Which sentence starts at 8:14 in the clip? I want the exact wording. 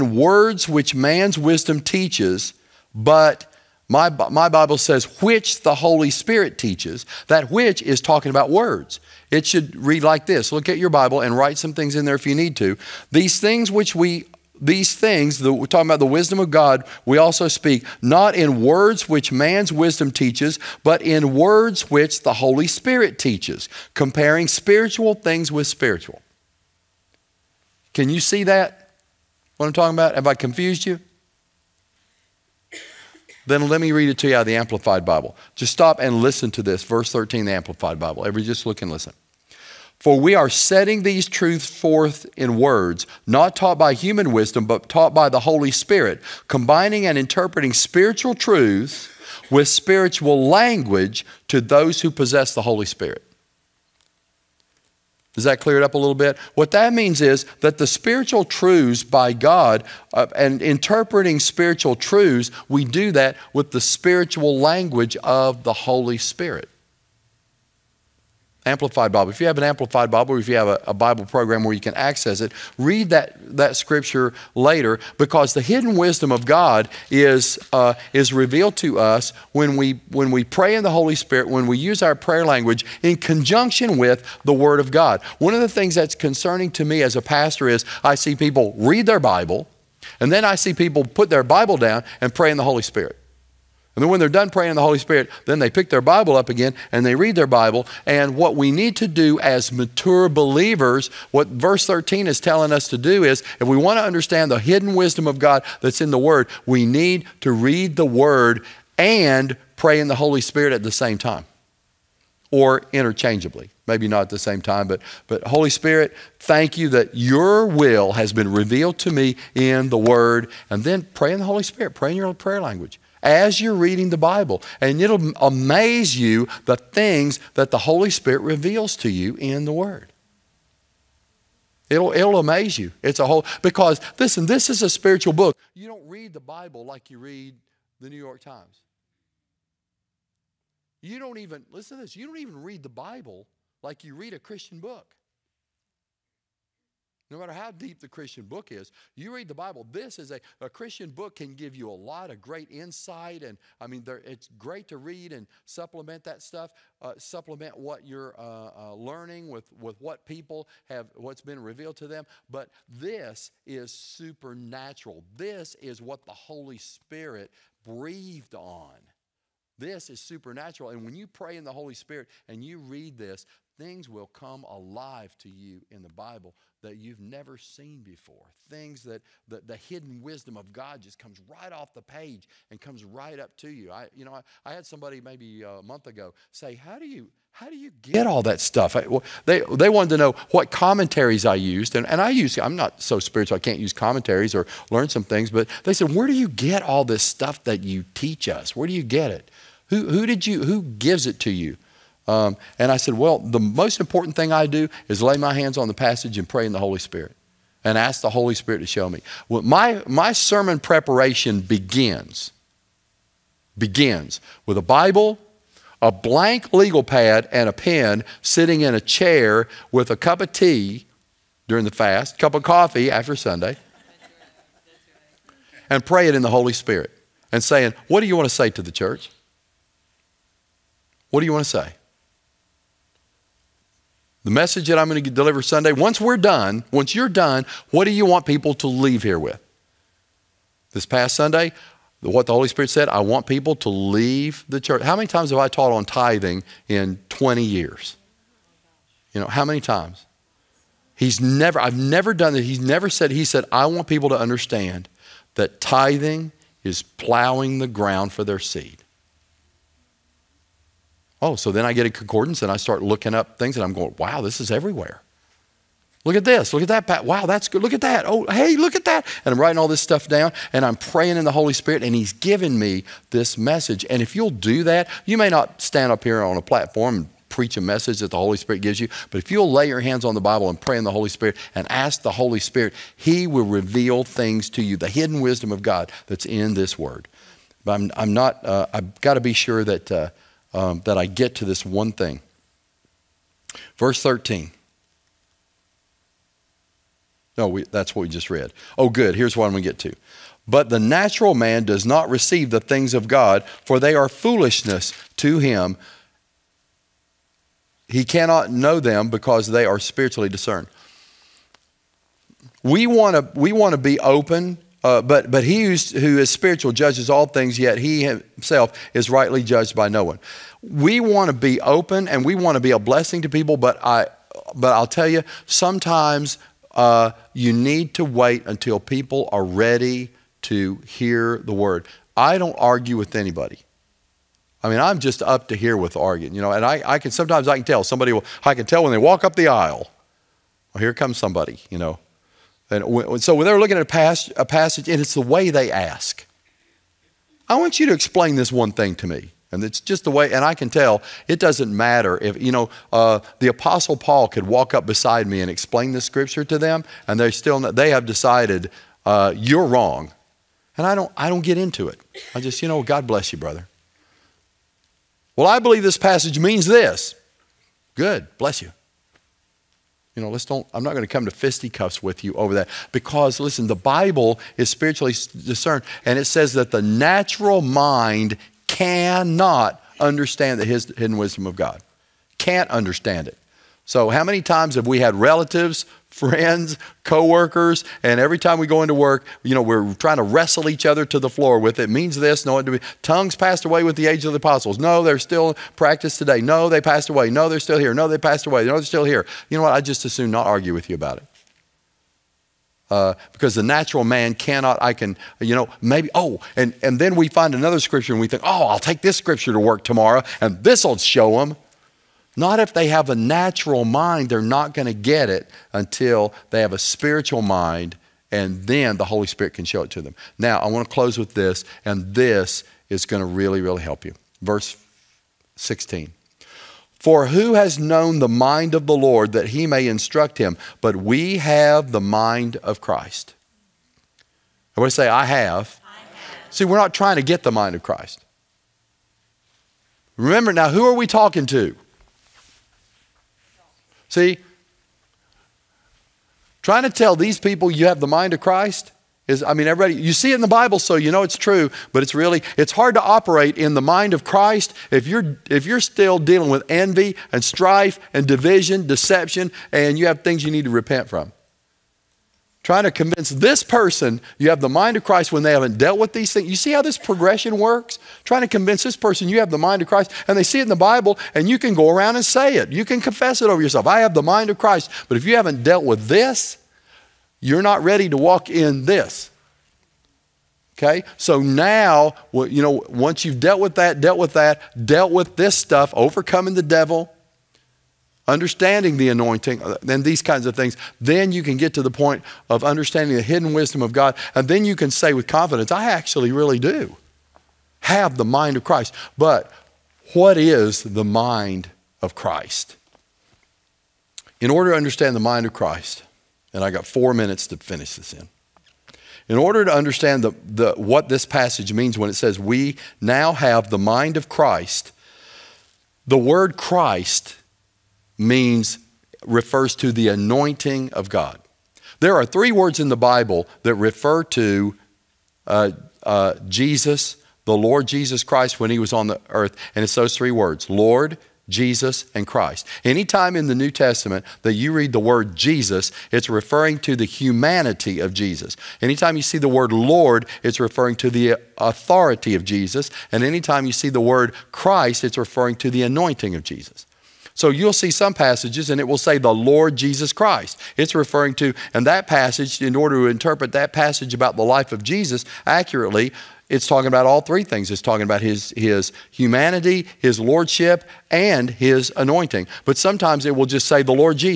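And then you can say with confidence, I actually really do have the mind of Christ.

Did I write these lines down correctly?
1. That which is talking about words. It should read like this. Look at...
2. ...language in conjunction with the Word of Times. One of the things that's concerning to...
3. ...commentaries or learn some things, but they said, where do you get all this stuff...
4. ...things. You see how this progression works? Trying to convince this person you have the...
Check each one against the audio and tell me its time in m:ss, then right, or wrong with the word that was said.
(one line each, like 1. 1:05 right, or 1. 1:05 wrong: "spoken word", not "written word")
1. 0:07 right
2. 1:22 wrong: "God", not "Times"
3. 3:13 right
4. 7:46 right.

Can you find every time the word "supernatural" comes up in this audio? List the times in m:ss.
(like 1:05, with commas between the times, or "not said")
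2:43, 2:50.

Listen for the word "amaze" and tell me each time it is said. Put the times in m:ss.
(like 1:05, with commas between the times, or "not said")
2:05, 2:12.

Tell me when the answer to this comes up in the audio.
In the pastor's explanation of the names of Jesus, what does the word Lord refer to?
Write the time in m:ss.
9:01.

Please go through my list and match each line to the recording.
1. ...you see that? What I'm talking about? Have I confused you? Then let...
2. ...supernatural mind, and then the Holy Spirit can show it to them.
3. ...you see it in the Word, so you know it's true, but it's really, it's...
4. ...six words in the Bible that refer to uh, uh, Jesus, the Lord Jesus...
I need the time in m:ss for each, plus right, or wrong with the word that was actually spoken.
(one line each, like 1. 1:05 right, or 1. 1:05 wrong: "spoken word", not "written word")
1. 0:28 right
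2. 6:56 wrong: "spiritual", not "supernatural"
3. 7:30 wrong: "Bible", not "Word"
4. 8:42 wrong: "three", not "six".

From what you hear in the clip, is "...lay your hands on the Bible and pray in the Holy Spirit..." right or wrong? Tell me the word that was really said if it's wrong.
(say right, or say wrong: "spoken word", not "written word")
right.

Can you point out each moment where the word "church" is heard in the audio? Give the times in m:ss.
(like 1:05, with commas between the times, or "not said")
3:48, 4:04.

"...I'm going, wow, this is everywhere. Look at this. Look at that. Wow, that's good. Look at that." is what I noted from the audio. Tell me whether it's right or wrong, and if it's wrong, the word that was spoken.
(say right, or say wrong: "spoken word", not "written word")
right.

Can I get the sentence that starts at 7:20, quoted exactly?
Remember now, who are we talking to?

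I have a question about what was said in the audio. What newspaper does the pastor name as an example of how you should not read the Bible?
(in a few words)
New York Times.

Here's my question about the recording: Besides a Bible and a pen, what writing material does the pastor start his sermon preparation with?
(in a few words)
blank legal pad.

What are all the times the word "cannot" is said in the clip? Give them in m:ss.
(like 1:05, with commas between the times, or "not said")
5:08, 6:18, 6:44.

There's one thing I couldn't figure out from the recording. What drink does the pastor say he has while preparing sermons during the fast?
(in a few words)
tea.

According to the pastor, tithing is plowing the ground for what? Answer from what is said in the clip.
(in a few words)
their seed.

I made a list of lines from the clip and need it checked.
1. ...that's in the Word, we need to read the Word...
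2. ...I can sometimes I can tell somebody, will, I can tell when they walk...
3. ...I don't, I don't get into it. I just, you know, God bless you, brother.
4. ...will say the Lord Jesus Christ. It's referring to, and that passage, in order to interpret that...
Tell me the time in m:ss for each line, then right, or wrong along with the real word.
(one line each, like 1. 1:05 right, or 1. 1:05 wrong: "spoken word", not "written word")
1. 1:45 right
2. 5:37 right
3. 6:01 right
4. 9:09 right.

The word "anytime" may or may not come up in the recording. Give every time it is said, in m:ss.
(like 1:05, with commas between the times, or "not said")
8:53, 8:59, 9:03.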